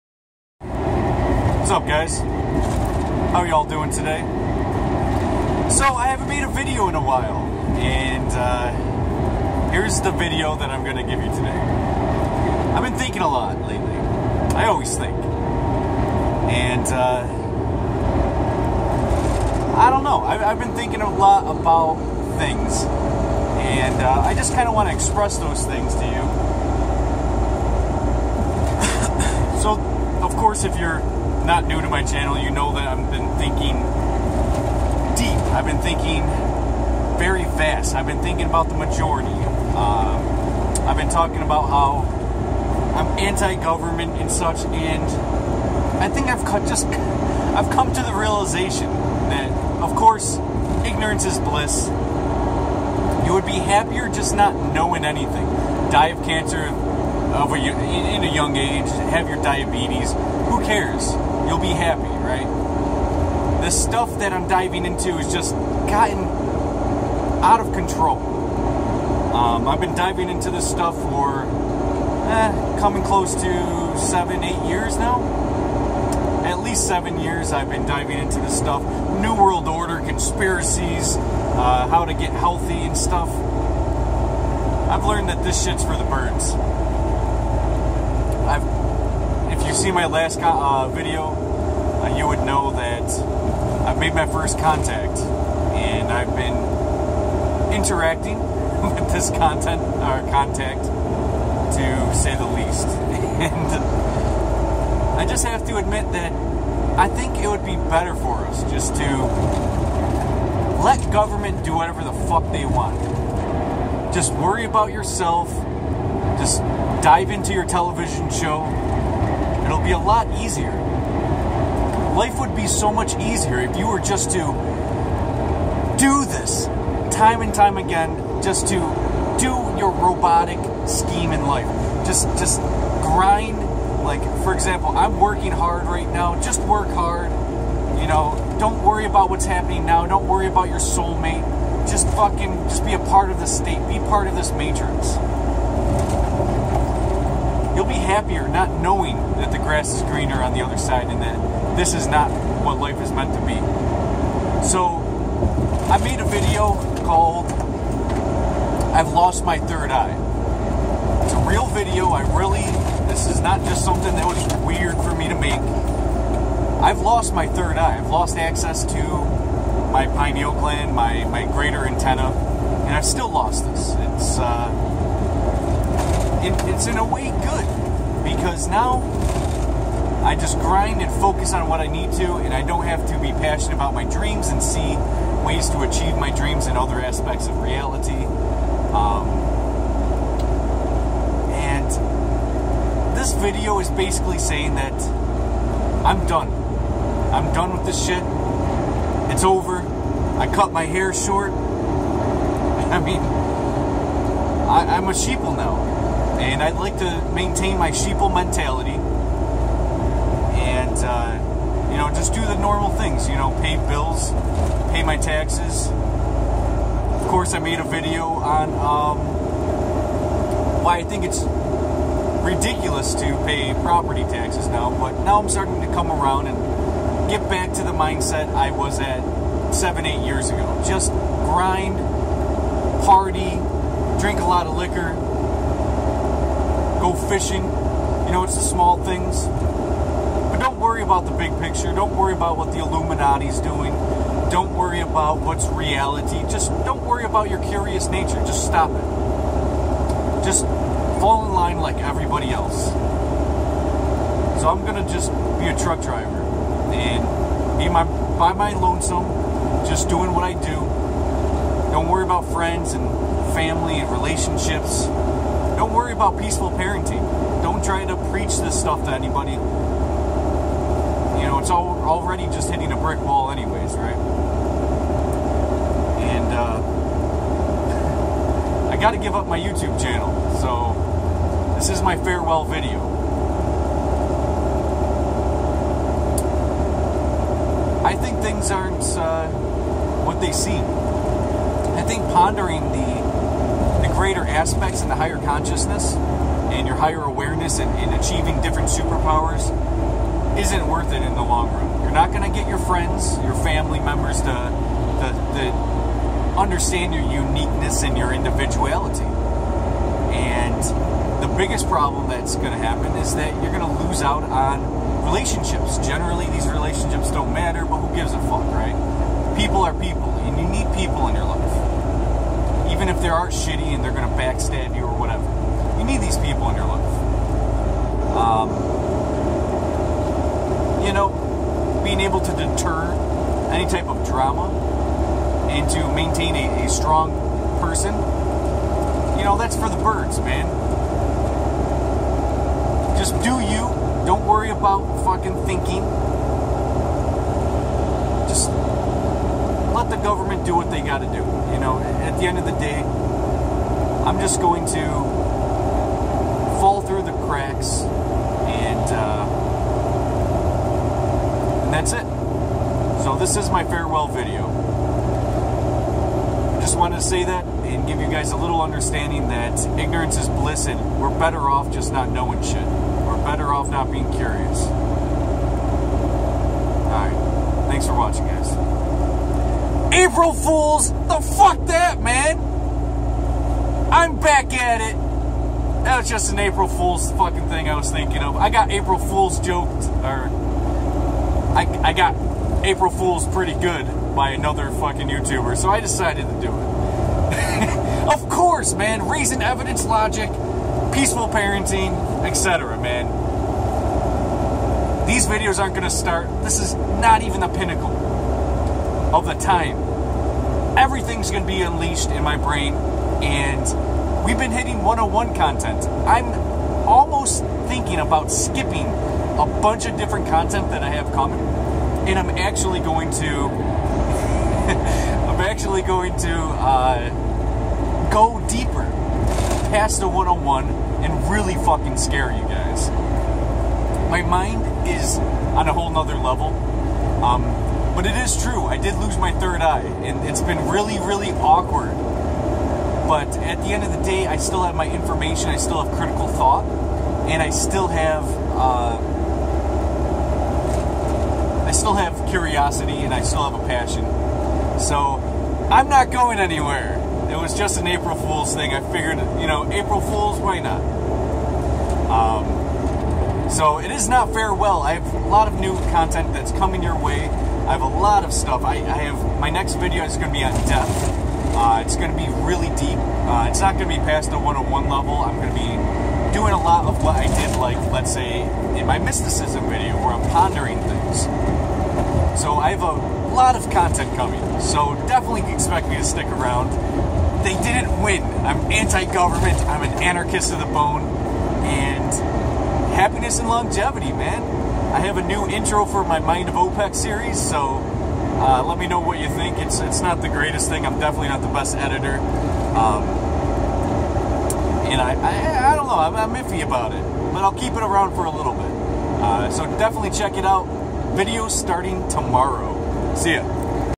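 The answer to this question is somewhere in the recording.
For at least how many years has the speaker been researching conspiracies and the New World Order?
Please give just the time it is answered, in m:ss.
1:16.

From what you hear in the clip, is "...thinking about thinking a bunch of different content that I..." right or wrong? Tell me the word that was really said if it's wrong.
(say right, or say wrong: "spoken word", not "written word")
wrong: "skipping", not "thinking".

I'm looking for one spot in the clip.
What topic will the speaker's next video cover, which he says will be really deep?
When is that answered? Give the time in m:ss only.
7:50.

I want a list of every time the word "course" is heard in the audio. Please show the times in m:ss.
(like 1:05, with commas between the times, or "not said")
0:30, 0:49, 3:37, 6:38.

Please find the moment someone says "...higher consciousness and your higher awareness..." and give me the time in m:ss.
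4:55.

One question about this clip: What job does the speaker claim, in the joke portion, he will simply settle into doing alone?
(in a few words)
Truck driver.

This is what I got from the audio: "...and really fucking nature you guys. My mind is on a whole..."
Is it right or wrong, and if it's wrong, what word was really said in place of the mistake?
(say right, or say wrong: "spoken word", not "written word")
wrong: "scare", not "nature".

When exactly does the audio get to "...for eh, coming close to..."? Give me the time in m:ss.
1:10.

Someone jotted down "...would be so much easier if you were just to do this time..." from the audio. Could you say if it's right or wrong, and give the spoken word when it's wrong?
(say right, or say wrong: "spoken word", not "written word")
right.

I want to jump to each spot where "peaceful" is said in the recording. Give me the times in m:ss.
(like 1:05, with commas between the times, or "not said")
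4:26, 6:41.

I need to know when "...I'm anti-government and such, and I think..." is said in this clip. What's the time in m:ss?
0:42.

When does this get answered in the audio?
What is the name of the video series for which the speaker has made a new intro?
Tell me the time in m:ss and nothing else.
8:16.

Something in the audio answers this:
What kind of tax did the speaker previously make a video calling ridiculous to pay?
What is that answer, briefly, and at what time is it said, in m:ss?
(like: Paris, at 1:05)
Property taxes, at 3:43.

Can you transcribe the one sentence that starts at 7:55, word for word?
I'm going to be doing a lot of what I did, like let's say in my mysticism video, where I'm pondering things.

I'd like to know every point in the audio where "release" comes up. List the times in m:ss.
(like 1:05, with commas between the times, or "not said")
not said.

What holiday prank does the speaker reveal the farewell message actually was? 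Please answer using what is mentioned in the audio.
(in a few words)
April Fools.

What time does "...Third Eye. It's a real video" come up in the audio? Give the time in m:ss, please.
2:39.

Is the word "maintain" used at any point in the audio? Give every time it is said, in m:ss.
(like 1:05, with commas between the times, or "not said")
3:27, 5:36.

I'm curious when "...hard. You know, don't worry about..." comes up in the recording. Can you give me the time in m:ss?
2:16.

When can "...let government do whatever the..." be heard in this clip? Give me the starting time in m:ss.
1:50.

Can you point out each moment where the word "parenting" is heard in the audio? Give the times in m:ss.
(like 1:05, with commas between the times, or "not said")
4:26, 6:41.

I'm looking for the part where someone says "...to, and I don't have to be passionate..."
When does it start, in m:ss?
3:02.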